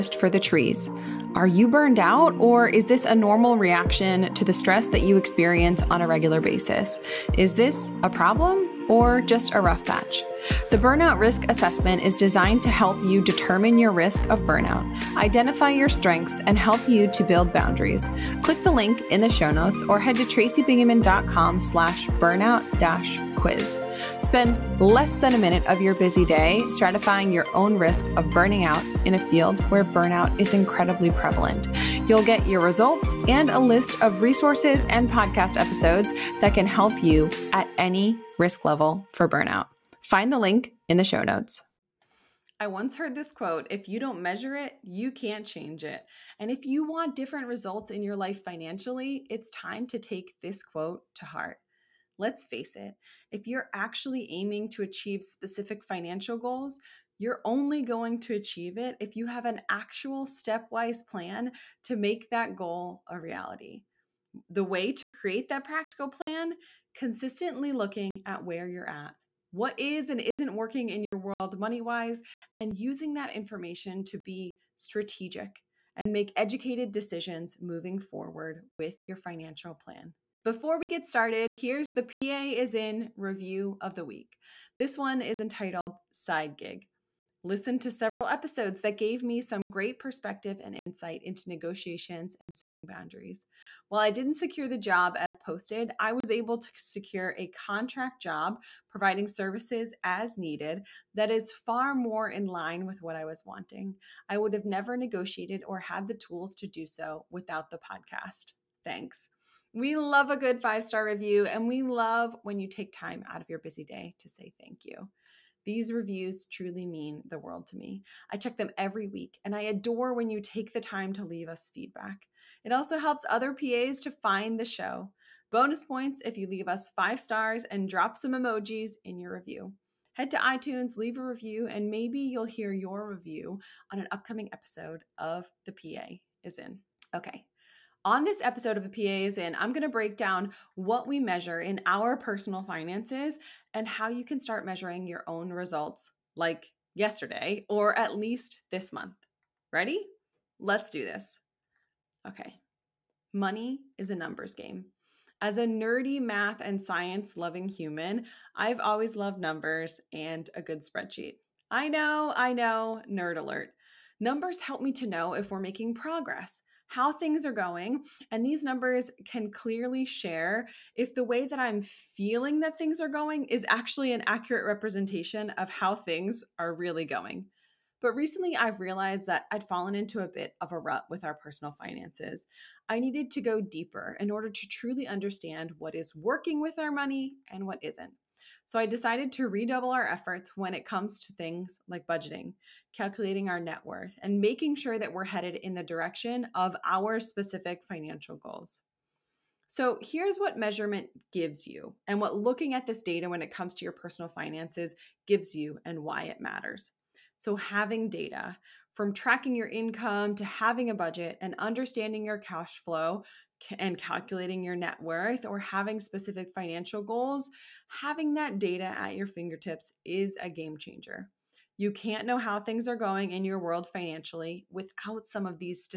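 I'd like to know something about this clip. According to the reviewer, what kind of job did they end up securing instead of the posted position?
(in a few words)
contract job.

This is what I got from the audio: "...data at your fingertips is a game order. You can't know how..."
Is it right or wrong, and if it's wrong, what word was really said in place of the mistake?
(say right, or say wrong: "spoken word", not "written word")
wrong: "changer", not "order".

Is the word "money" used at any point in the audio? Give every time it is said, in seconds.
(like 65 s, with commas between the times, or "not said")
71 s, 153 s, 186 s.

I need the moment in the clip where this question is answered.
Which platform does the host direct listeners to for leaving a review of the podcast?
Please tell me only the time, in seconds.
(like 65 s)
130 s.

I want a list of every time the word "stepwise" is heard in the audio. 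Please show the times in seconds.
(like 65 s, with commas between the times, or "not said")
60 s.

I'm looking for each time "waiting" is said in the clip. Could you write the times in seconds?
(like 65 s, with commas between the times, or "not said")
not said.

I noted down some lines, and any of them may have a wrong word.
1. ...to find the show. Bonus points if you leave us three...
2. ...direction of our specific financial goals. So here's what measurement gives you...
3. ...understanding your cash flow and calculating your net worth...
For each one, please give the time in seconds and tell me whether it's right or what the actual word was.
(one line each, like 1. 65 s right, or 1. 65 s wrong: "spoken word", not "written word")
1. 124 s wrong: "five", not "three"
2. 195 s right
3. 211 s right.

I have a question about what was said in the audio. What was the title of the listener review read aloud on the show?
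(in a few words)
Side Gig.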